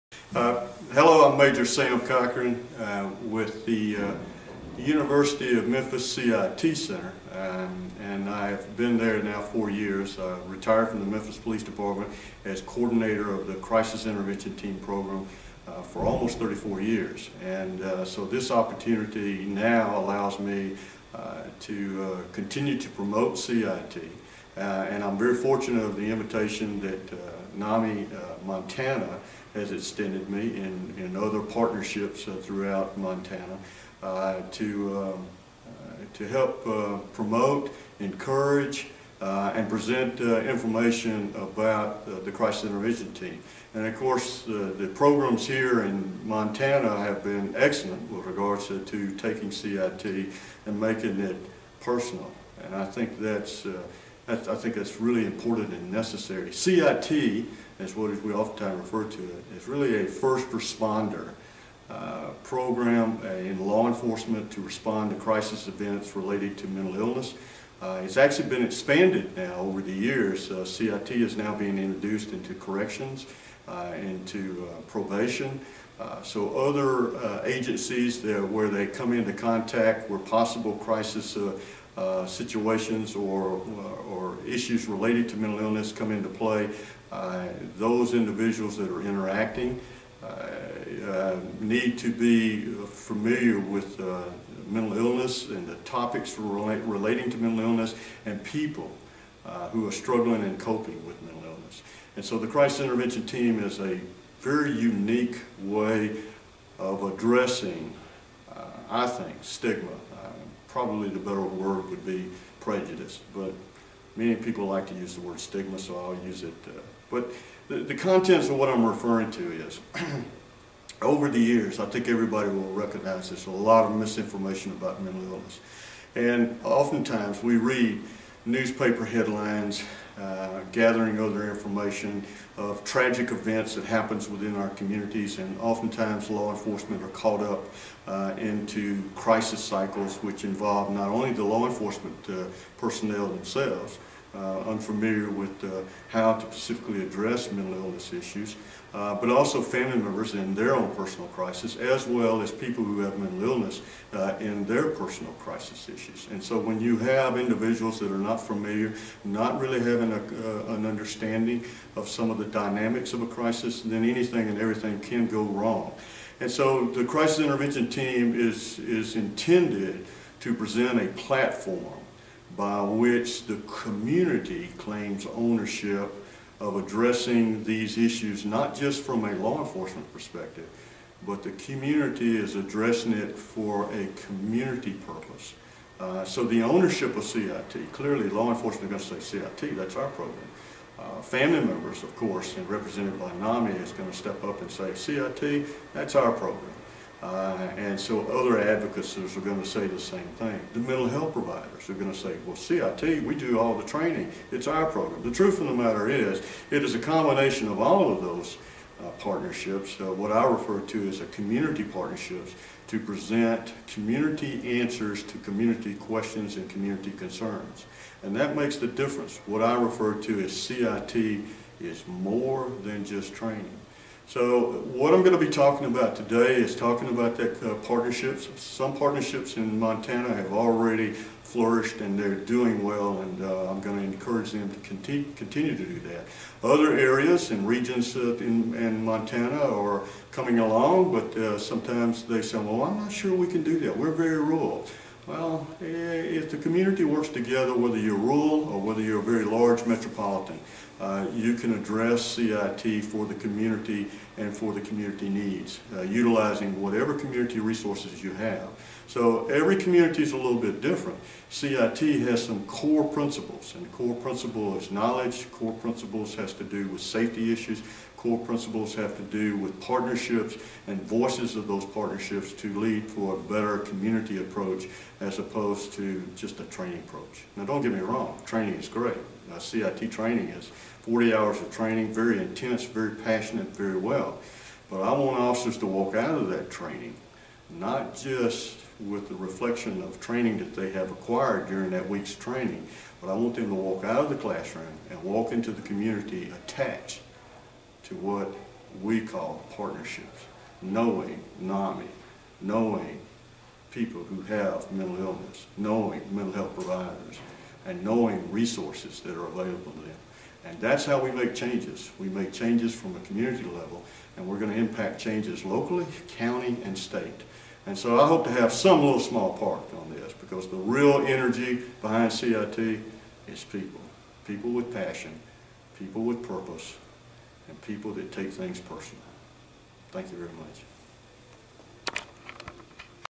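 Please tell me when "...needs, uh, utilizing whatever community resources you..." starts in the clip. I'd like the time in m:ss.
4:15.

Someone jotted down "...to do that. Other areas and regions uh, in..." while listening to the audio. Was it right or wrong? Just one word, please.
right.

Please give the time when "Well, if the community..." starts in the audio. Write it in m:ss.
4:05.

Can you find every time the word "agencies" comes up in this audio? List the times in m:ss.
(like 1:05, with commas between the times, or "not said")
1:17.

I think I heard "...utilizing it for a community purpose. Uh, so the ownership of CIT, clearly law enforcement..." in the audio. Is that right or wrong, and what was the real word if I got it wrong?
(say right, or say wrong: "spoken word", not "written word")
wrong: "addressing", not "utilizing".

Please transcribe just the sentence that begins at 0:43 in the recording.
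And of course, the programs here in Montana have been excellent with regards to, to taking CIT and making it personal.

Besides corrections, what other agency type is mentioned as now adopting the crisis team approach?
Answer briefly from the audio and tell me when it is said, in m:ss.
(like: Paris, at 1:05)
Probation, at 1:14.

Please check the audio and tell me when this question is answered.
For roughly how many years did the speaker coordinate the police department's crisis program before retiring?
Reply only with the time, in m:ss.
0:16.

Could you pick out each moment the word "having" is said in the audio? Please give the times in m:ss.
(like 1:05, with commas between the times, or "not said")
2:39.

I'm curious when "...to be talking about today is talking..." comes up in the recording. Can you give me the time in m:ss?
3:45.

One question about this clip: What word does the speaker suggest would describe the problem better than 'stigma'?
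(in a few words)
Prejudice.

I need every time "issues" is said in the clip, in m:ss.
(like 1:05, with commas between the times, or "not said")
1:24, 2:28, 2:35, 2:57, 4:27.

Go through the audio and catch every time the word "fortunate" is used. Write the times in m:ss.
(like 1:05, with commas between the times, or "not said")
0:25.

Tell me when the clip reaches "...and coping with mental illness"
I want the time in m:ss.
1:40.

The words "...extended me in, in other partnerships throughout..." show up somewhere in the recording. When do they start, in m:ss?
0:29.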